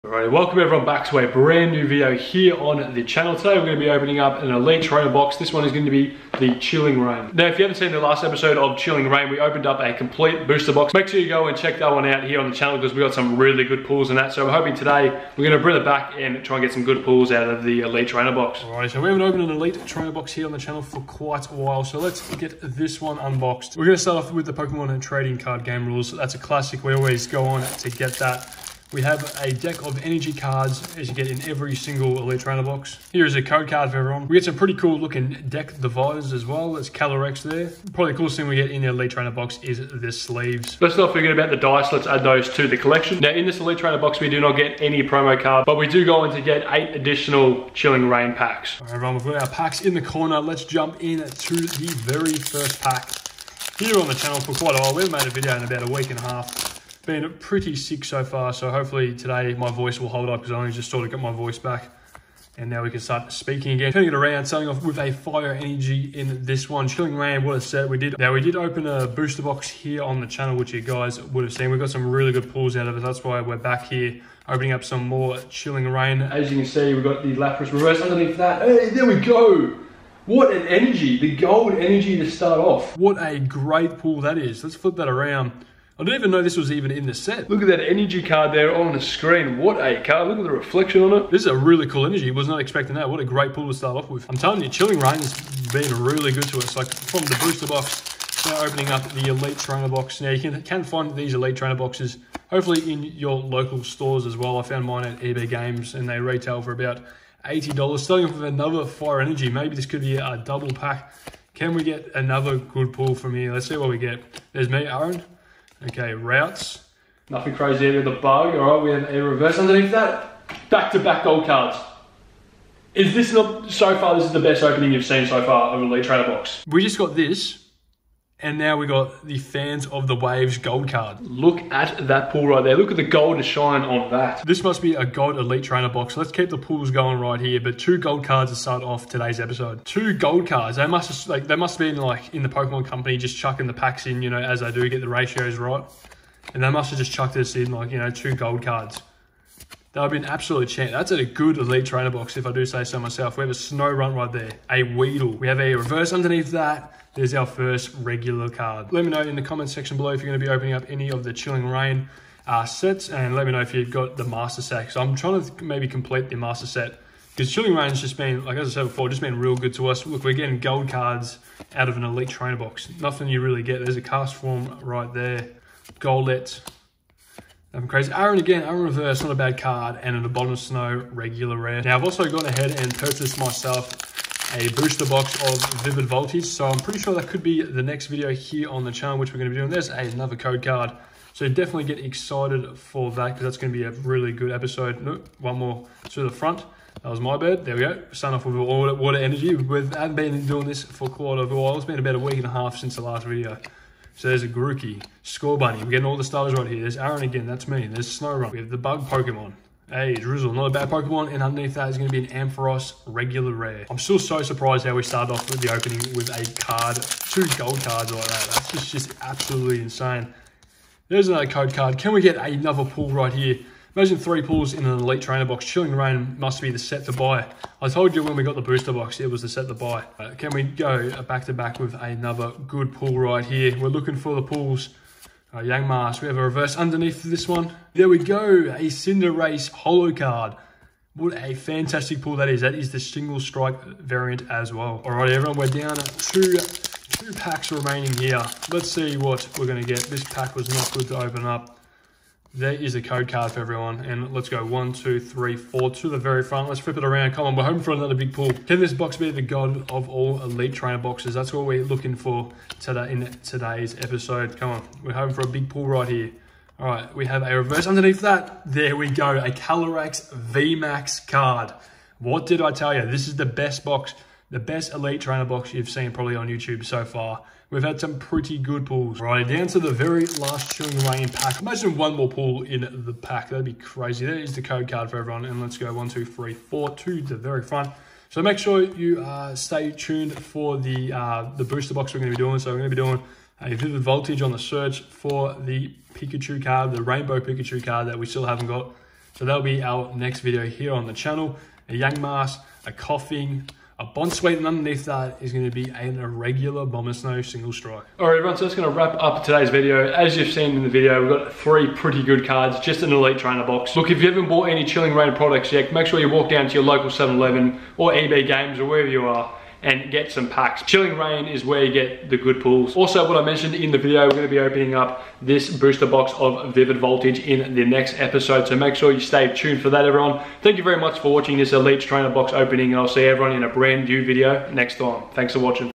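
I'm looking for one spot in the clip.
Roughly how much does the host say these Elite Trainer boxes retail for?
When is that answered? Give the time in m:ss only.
1:46.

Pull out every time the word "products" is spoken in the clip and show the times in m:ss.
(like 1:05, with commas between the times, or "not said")
5:15.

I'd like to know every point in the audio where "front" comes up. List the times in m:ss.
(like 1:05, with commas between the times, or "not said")
3:16, 4:16, 4:47.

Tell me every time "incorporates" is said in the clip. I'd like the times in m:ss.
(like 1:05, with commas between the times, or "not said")
not said.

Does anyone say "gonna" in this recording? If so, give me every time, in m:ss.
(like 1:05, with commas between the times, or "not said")
3:09, 3:13, 5:24.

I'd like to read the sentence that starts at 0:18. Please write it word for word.
All right, so we haven't opened an Elite Trainer box here on the channel for quite a while.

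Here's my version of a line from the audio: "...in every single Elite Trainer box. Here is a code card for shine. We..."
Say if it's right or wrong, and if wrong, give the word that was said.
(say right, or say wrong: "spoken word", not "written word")
wrong: "everyone", not "shine".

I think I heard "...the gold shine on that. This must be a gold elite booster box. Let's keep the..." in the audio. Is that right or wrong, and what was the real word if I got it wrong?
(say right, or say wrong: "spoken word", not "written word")
wrong: "trainer", not "booster".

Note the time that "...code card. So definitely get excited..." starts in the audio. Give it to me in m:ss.
3:10.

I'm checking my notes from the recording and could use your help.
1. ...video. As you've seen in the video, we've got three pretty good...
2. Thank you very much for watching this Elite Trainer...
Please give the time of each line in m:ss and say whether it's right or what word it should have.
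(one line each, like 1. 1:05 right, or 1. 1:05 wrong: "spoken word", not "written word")
1. 5:09 right
2. 5:30 right.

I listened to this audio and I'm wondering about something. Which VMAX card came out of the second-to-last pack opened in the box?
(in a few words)
Calyrex VMAX.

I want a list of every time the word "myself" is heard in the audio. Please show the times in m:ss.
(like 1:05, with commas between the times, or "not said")
2:32, 3:03.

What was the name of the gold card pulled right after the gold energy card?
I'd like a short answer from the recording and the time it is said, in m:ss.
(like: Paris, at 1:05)
Fans of the Waves, at 2:09.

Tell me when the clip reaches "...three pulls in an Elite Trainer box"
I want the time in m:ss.
3:44.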